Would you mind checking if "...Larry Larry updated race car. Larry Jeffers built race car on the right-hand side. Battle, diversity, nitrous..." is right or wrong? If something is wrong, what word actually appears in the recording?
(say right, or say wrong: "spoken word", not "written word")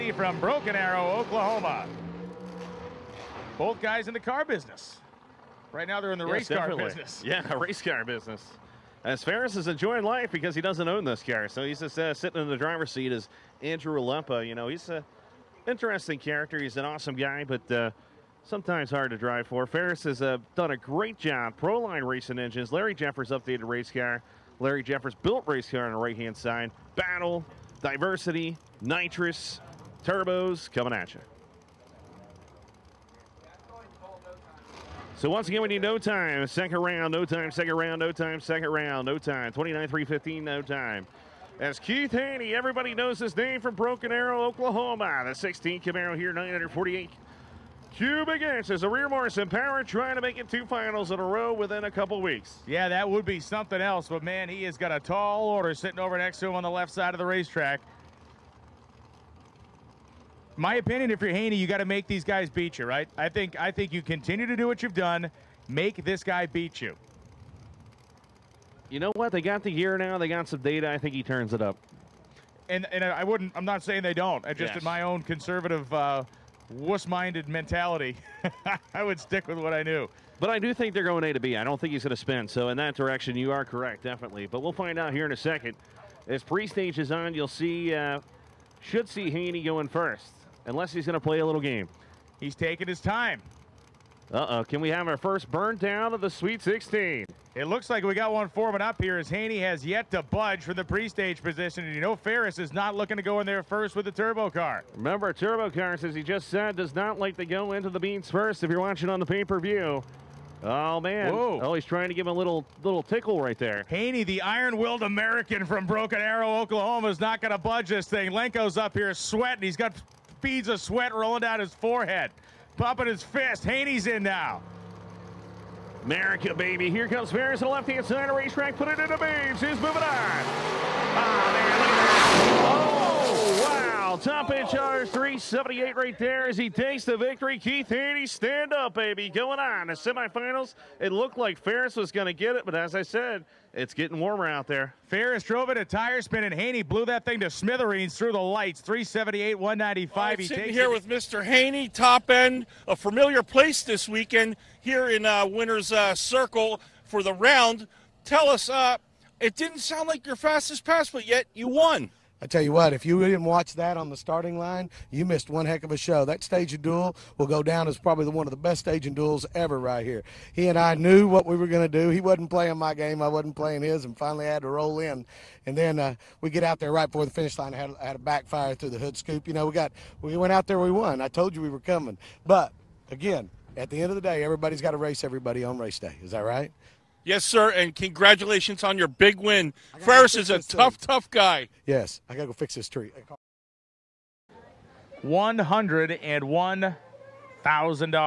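wrong: "Jeffers", not "Larry".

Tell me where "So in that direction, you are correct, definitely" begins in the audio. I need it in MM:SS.
01:22.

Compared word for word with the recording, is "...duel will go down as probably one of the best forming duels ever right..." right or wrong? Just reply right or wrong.
wrong.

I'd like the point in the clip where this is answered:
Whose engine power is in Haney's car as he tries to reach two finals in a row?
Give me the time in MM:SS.
00:48.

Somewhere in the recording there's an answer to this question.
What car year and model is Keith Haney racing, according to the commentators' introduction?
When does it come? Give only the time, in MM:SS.
00:45.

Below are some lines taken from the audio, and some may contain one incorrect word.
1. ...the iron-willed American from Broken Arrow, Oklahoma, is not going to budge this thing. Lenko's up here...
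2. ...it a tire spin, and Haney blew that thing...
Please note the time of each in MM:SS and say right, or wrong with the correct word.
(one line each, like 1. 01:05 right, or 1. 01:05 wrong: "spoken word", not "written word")
1. 01:54 right
2. 02:25 right.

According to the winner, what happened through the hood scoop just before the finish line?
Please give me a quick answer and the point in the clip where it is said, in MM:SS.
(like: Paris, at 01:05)
a backfire, at 02:58.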